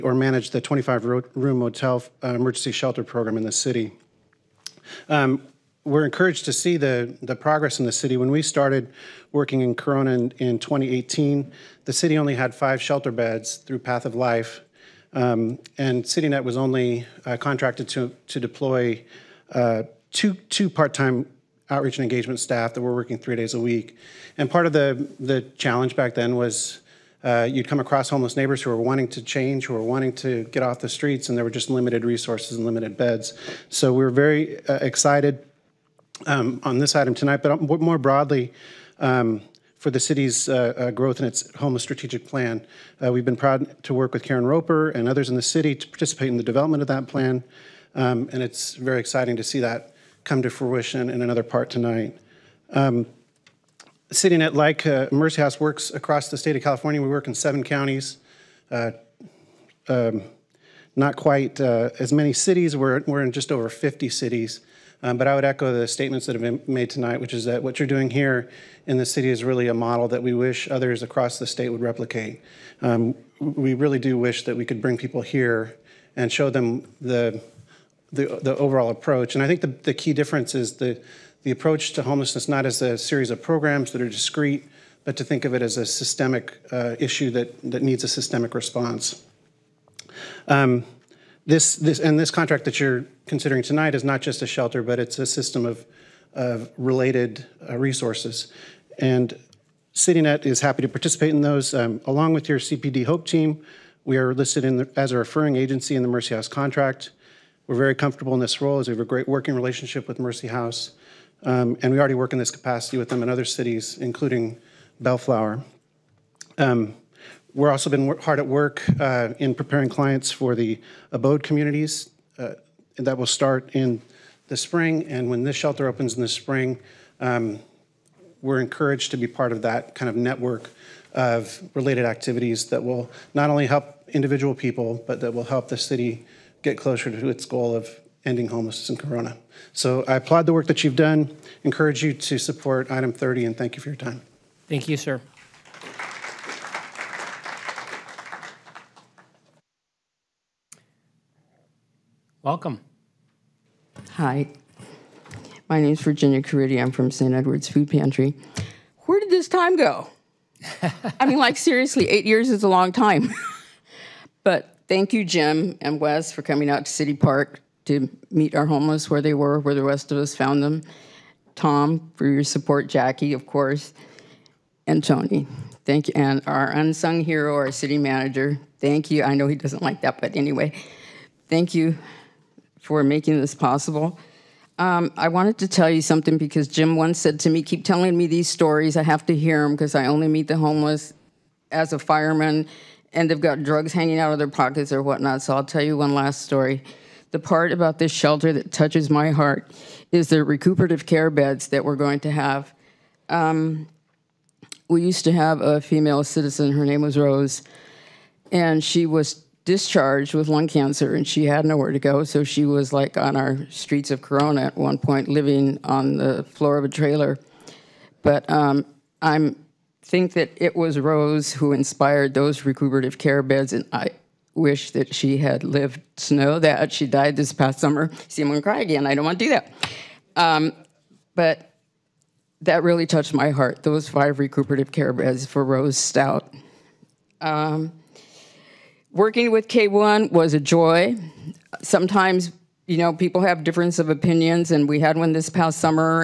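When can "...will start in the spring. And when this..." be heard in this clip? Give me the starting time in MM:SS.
02:03.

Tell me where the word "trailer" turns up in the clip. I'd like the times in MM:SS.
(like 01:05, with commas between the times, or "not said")
03:36.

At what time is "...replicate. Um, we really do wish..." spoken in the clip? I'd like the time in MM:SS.
01:11.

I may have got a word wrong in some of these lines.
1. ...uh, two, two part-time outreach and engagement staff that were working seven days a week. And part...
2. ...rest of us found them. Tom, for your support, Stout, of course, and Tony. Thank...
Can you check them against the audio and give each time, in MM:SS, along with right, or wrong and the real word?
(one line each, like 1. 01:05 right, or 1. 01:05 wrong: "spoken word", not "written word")
1. 00:19 wrong: "three", not "seven"
2. 02:49 wrong: "Jackie", not "Stout".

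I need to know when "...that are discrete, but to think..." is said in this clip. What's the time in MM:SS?
01:23.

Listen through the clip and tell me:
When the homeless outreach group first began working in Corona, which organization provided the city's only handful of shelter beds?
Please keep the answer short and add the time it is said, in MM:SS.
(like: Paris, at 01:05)
Path of Life, at 00:13.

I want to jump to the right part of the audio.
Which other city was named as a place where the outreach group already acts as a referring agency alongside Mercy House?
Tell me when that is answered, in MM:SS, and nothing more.
01:54.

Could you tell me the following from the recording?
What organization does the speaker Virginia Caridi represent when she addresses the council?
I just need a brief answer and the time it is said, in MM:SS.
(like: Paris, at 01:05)
St. Edward's Food Pantry, at 02:37.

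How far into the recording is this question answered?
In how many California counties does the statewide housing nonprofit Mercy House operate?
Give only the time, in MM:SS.
00:57.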